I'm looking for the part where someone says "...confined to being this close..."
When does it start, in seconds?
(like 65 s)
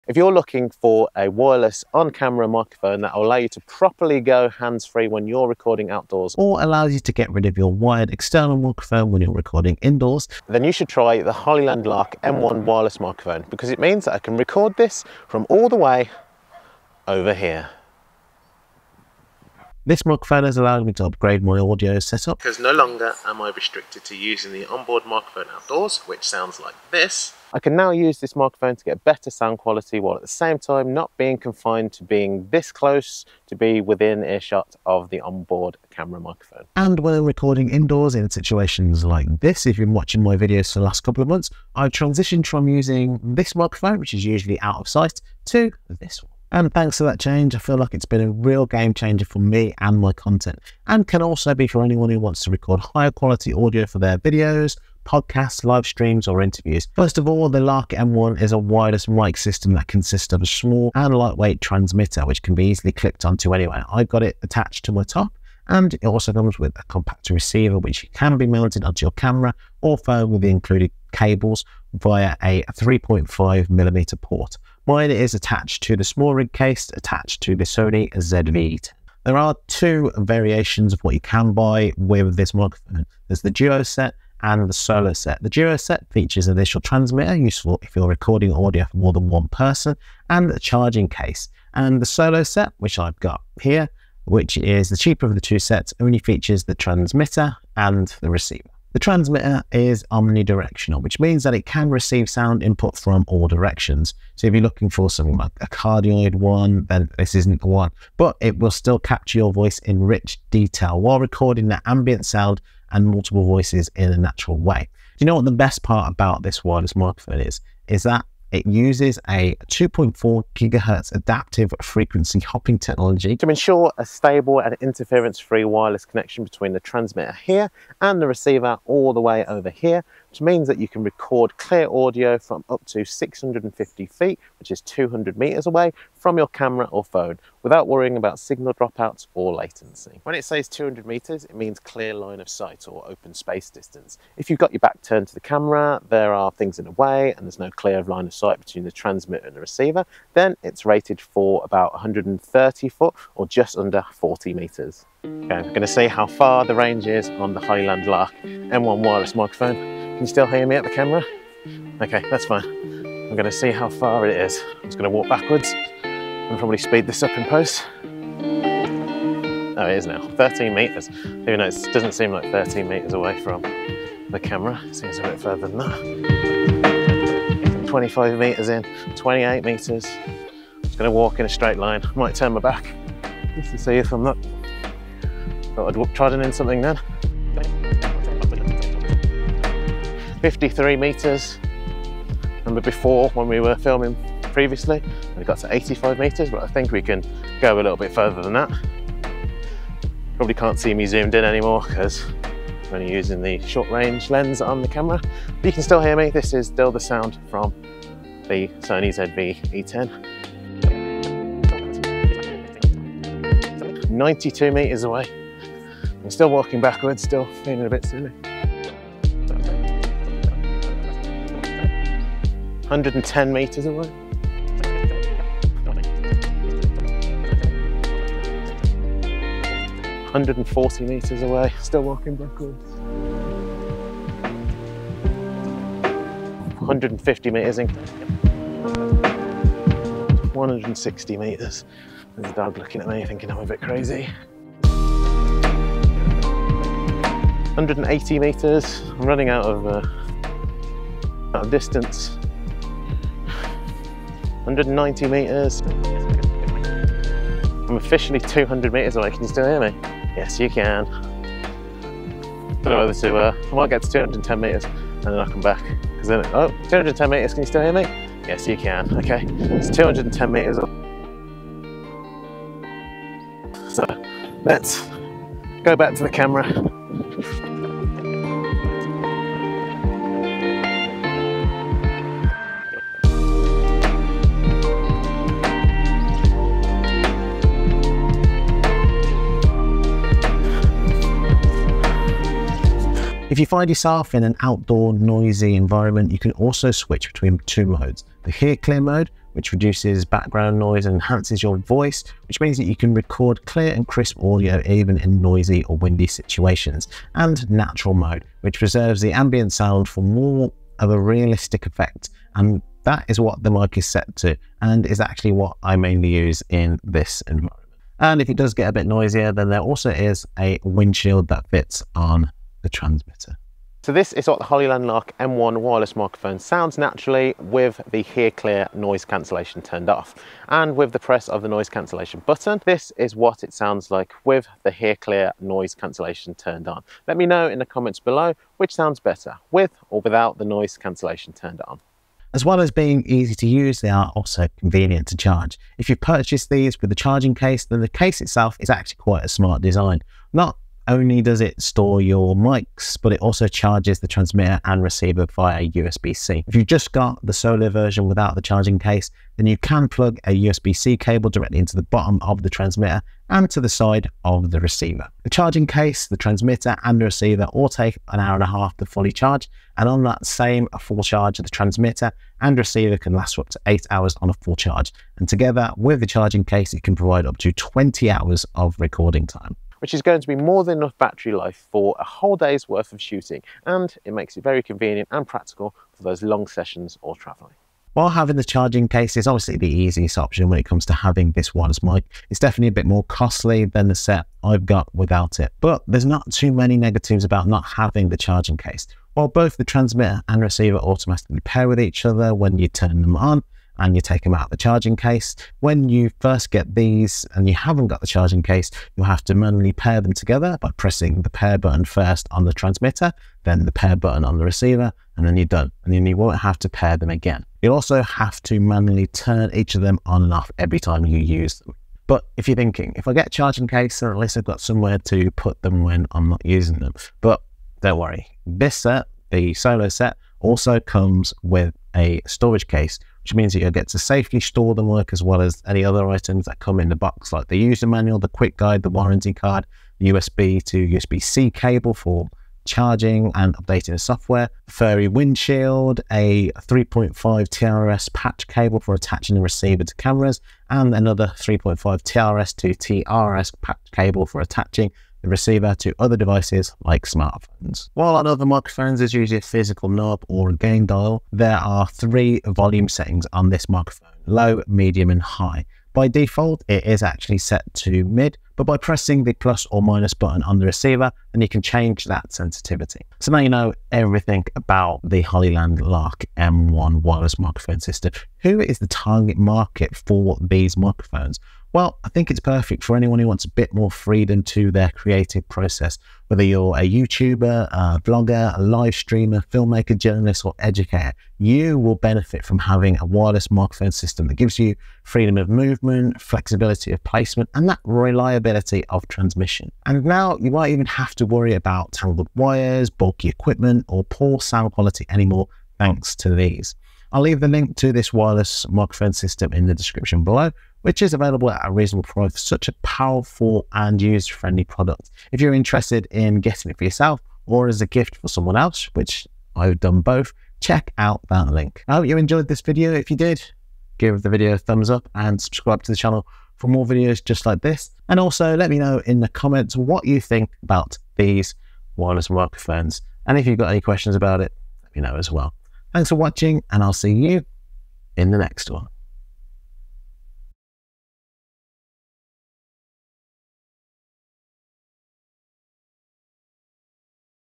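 31 s.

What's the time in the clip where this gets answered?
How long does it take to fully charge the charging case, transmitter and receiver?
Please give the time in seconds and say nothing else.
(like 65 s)
368 s.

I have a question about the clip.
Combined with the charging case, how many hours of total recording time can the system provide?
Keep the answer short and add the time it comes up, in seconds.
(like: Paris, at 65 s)
20 hours, at 377 s.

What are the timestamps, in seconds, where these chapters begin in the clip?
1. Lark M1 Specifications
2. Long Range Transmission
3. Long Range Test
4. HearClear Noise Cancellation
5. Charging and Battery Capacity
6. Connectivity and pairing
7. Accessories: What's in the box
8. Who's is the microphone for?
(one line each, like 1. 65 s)
1. 55 s
2. 114 s
3. 155 s
4. 292 s
5. 343 s
6. 388 s
7. 427 s
8. 472 s.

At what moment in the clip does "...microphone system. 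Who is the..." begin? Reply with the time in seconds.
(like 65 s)
477 s.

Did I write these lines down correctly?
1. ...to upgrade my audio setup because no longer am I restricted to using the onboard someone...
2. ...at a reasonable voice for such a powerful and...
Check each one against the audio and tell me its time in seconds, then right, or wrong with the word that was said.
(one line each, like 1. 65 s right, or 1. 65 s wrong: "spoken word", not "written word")
1. 20 s wrong: "microphone", not "someone"
2. 511 s wrong: "price", not "voice".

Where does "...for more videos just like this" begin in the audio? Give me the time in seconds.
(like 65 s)
526 s.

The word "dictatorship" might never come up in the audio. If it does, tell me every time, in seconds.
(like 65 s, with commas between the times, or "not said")
not said.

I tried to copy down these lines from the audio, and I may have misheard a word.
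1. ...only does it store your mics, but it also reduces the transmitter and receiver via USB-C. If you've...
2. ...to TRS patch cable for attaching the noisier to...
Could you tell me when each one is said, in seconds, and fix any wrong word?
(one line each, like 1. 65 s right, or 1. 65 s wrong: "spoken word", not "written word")
1. 351 s wrong: "charges", not "reduces"
2. 452 s wrong: "receiver", not "noisier".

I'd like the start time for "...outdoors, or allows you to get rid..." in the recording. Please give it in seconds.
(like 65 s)
5 s.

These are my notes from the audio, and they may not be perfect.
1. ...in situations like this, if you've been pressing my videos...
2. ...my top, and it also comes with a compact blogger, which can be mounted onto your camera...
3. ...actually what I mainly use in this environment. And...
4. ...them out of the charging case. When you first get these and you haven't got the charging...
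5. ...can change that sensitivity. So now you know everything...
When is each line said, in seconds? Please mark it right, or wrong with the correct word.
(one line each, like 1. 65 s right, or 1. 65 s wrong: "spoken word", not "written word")
1. 38 s wrong: "watching", not "pressing"
2. 64 s wrong: "receiver", not "blogger"
3. 315 s right
4. 404 s right
5. 471 s right.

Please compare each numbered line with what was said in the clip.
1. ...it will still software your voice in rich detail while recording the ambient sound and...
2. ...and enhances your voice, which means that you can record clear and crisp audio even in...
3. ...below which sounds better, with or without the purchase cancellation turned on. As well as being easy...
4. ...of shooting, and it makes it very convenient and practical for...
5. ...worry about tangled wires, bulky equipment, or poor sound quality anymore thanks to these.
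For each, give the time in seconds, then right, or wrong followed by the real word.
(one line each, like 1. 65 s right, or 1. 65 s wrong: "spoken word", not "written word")
1. 108 s wrong: "capture", not "software"
2. 301 s right
3. 338 s wrong: "noise", not "purchase"
4. 383 s right
5. 501 s right.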